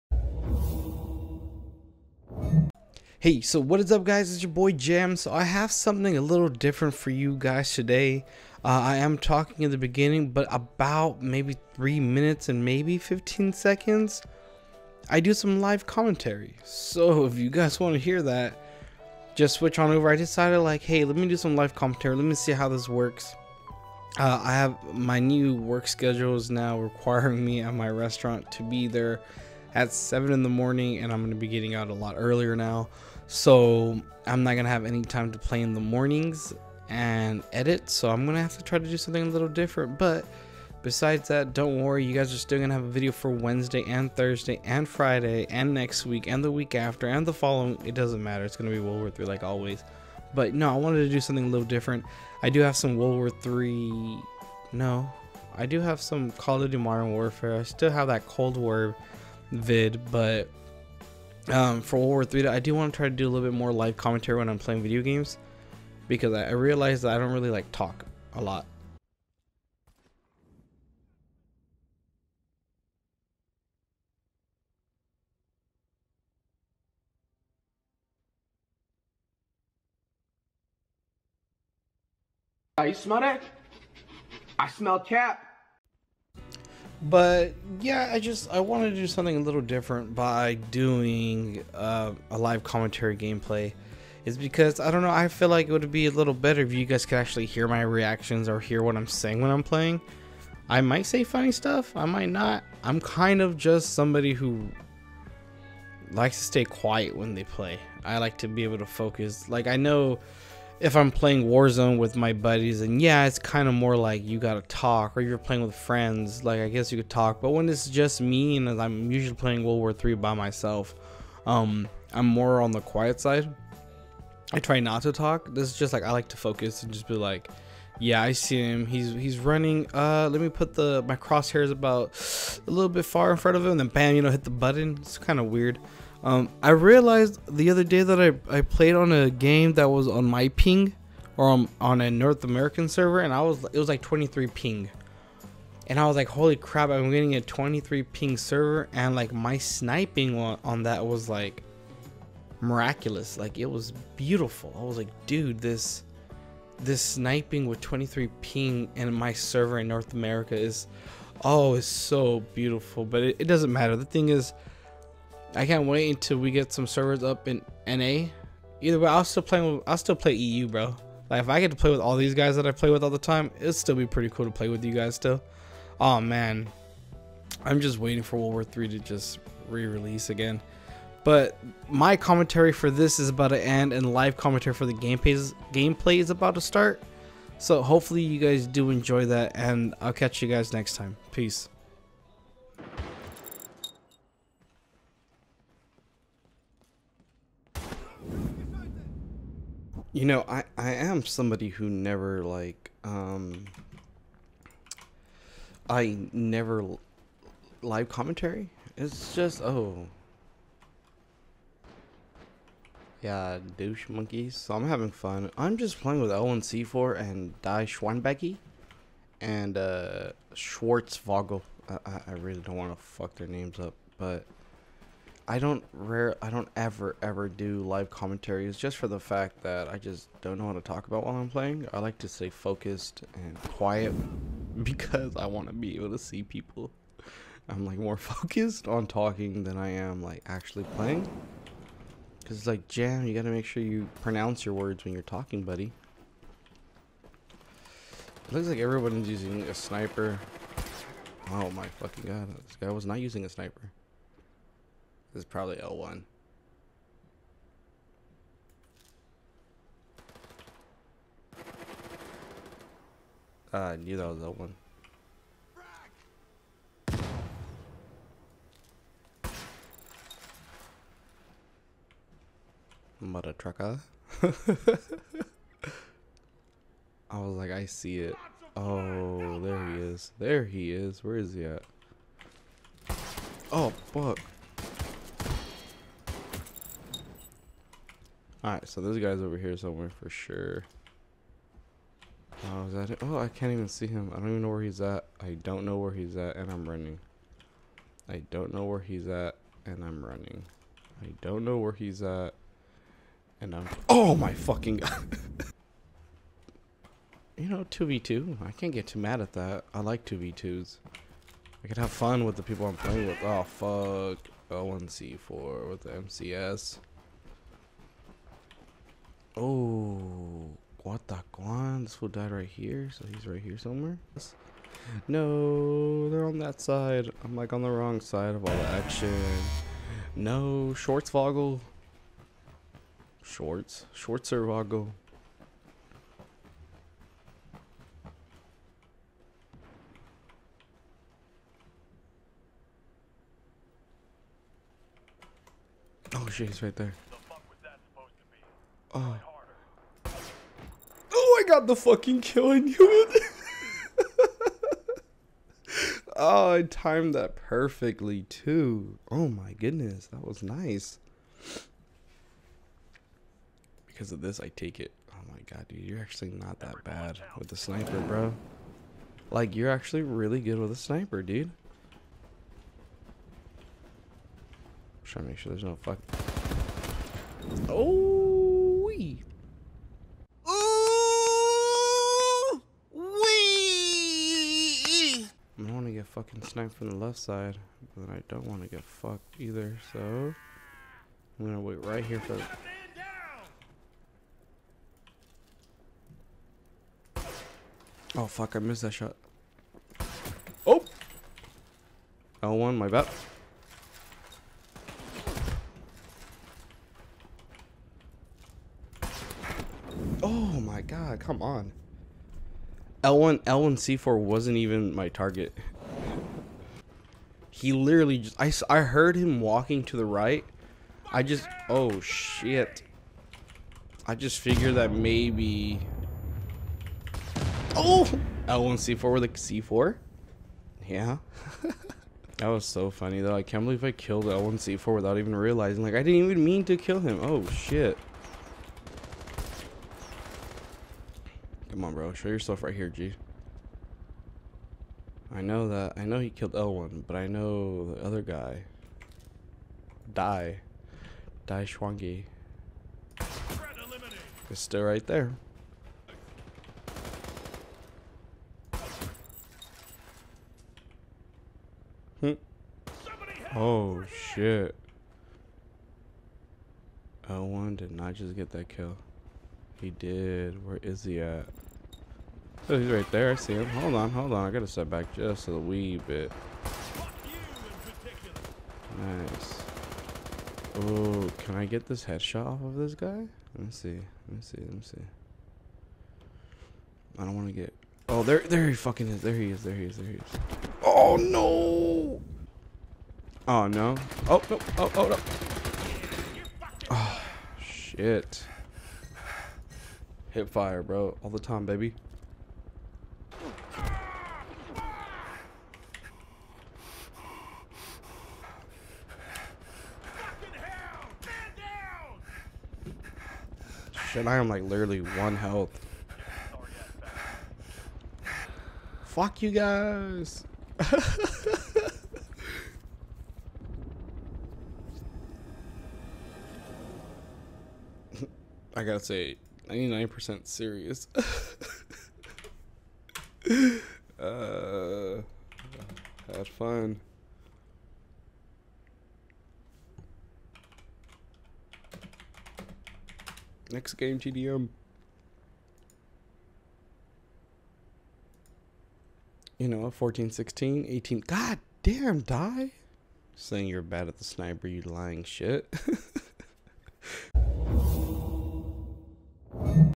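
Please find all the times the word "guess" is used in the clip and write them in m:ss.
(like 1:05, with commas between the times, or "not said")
1:56.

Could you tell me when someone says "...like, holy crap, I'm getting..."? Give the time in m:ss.
2:26.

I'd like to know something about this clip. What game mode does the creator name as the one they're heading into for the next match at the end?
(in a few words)
TDM.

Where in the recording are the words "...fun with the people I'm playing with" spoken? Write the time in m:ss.
5:12.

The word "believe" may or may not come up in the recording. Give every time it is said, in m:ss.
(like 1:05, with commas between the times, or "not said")
7:13.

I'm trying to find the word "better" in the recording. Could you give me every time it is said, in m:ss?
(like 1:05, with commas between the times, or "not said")
1:36.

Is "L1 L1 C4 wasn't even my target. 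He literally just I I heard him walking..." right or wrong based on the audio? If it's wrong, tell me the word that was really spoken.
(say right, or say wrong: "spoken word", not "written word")
right.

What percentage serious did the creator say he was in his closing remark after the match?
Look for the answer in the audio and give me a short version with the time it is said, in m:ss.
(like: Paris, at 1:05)
99%, at 8:49.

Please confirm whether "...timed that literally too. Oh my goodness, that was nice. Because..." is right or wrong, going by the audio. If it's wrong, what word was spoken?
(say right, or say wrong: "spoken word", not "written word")
wrong: "perfectly", not "literally".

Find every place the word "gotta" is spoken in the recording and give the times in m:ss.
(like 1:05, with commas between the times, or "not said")
1:54, 4:03, 7:54, 8:49.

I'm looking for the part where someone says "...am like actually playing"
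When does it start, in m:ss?
3:59.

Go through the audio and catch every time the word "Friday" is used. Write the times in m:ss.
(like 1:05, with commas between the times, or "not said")
0:44.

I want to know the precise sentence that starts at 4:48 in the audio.
Alright, so this guy's over here somewhere for sure.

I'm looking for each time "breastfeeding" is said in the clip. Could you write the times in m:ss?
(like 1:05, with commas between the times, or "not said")
not said.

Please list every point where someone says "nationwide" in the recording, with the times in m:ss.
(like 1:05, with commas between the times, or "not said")
not said.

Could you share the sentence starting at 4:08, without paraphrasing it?
It looks like everyone's using a sniper.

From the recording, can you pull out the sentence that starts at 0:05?
So I have something a little different for you guys today.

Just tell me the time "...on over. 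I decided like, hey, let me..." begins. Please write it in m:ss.
0:19.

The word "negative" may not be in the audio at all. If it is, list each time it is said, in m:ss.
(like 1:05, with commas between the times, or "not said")
not said.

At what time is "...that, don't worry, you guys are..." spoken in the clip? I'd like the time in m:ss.
0:41.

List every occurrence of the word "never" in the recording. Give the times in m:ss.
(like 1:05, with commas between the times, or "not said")
3:21, 3:26.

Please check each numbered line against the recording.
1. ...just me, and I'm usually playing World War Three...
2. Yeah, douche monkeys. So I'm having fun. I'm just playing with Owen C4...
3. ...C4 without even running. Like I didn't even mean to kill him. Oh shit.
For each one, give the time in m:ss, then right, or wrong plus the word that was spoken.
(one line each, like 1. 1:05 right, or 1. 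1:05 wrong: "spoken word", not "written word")
1. 1:57 right
2. 3:33 right
3. 7:14 wrong: "realizing", not "running".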